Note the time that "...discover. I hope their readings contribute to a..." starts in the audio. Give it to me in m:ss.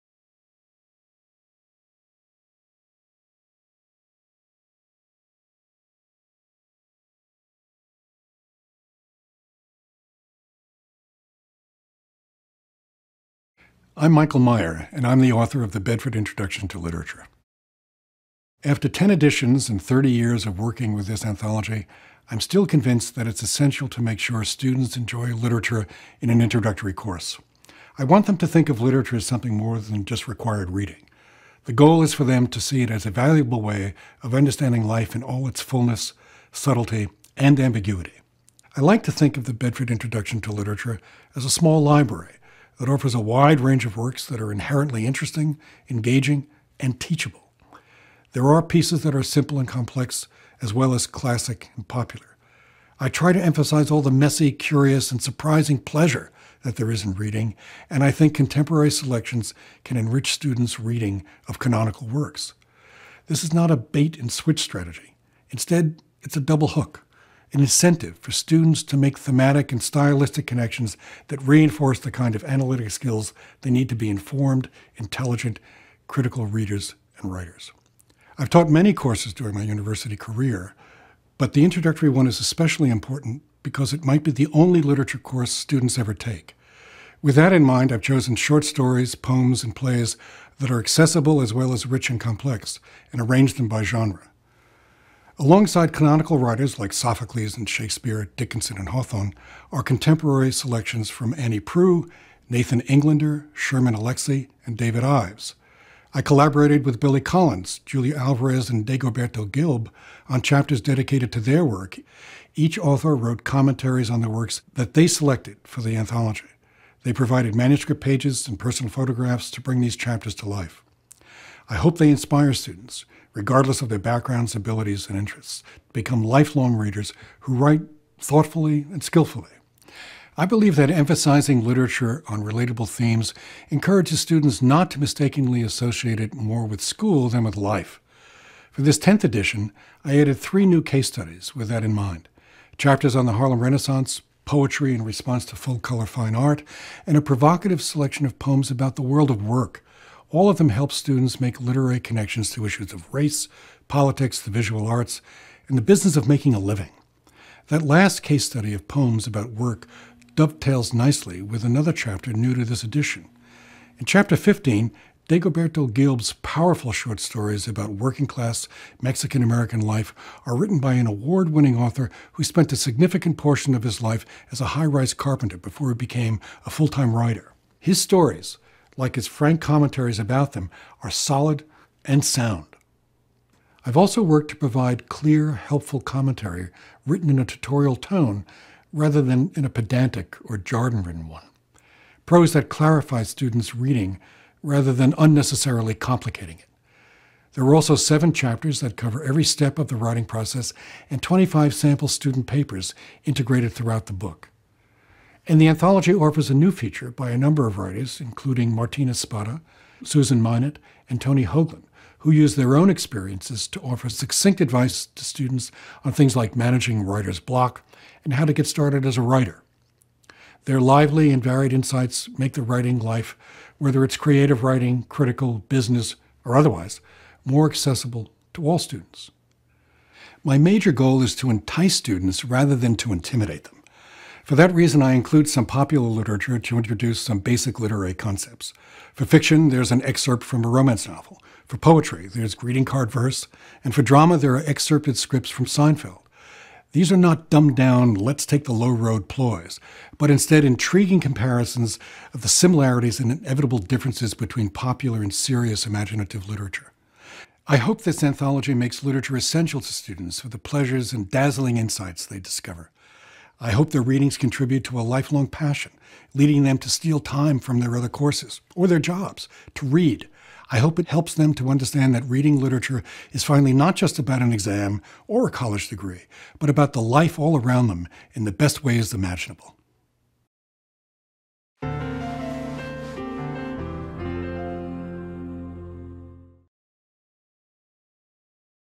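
4:22.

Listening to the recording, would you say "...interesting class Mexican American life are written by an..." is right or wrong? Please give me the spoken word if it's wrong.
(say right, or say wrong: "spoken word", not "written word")
wrong: "working", not "interesting".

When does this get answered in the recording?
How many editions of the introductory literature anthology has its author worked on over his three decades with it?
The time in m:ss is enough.
0:18.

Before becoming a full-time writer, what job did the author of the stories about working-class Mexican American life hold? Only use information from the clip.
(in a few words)
high rise carpenter.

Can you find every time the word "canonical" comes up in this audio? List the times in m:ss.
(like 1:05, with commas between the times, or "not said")
1:01, 1:35.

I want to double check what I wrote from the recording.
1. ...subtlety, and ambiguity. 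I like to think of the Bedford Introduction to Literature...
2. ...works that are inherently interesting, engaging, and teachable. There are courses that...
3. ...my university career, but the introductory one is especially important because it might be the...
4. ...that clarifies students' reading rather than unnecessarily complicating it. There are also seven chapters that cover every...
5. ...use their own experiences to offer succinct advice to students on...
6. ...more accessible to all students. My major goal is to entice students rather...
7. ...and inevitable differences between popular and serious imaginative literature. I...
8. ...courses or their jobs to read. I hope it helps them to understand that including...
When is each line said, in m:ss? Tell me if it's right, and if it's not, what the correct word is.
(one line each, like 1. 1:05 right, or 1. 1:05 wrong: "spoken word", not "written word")
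1. 0:36 right
2. 0:43 wrong: "pieces", not "courses"
3. 1:19 right
4. 3:12 right
5. 3:32 right
6. 3:47 right
7. 4:13 right
8. 4:28 wrong: "reading", not "including".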